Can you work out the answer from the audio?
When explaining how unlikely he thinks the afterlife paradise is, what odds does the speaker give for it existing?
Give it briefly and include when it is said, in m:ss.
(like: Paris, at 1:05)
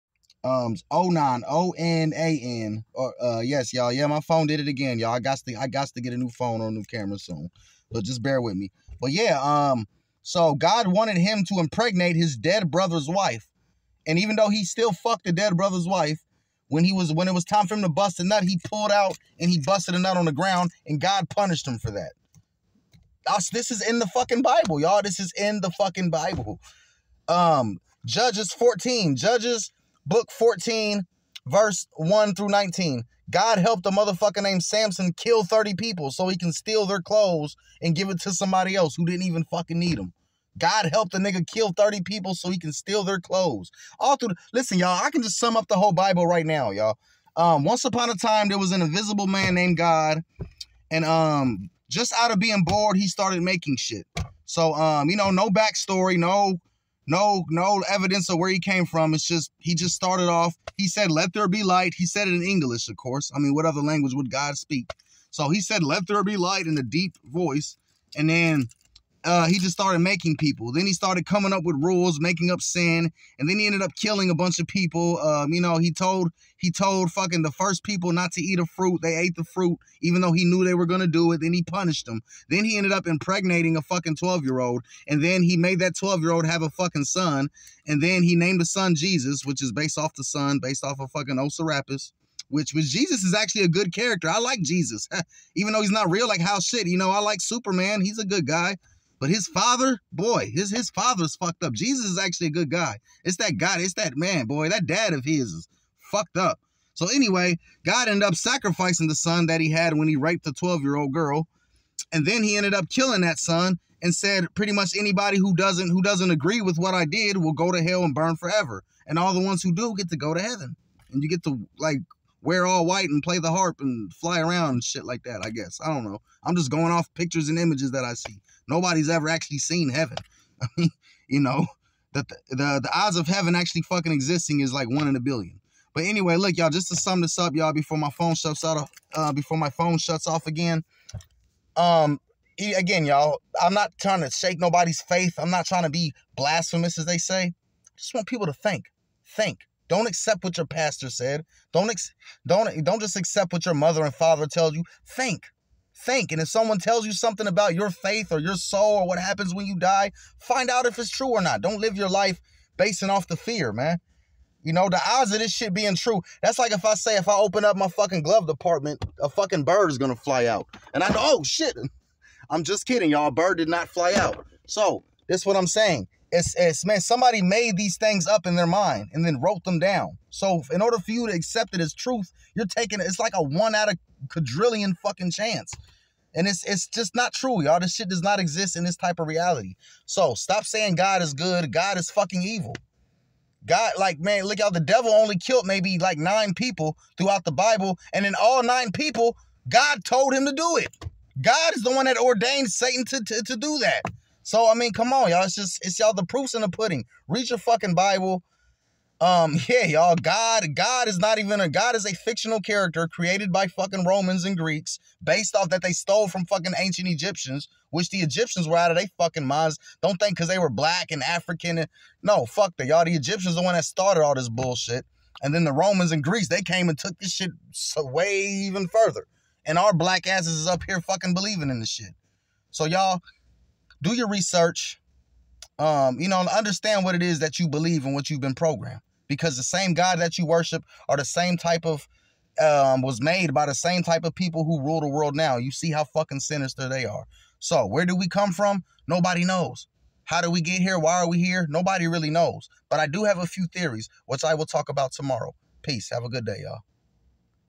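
1 in a billion, at 2:14.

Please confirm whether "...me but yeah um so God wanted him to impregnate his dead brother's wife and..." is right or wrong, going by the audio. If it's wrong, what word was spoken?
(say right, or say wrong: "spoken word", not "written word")
right.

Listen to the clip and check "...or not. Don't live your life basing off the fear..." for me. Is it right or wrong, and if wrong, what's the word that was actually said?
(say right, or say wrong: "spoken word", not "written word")
right.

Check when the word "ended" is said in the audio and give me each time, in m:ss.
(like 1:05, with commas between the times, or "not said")
1:13, 1:22, 1:48, 1:52.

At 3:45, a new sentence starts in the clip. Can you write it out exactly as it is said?
And then the Romans and Greeks, they came and took this shit way even further.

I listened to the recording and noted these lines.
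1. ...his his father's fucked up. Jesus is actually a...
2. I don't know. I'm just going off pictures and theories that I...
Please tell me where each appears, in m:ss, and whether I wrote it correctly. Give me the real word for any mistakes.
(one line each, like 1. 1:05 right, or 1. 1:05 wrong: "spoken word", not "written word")
1. 1:40 right
2. 2:05 wrong: "images", not "theories".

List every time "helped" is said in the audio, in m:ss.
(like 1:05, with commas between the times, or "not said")
0:33, 0:40.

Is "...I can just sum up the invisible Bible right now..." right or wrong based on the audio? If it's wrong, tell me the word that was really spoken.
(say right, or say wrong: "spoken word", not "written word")
wrong: "whole", not "invisible".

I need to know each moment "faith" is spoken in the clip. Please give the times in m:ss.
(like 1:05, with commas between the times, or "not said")
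2:25, 2:37.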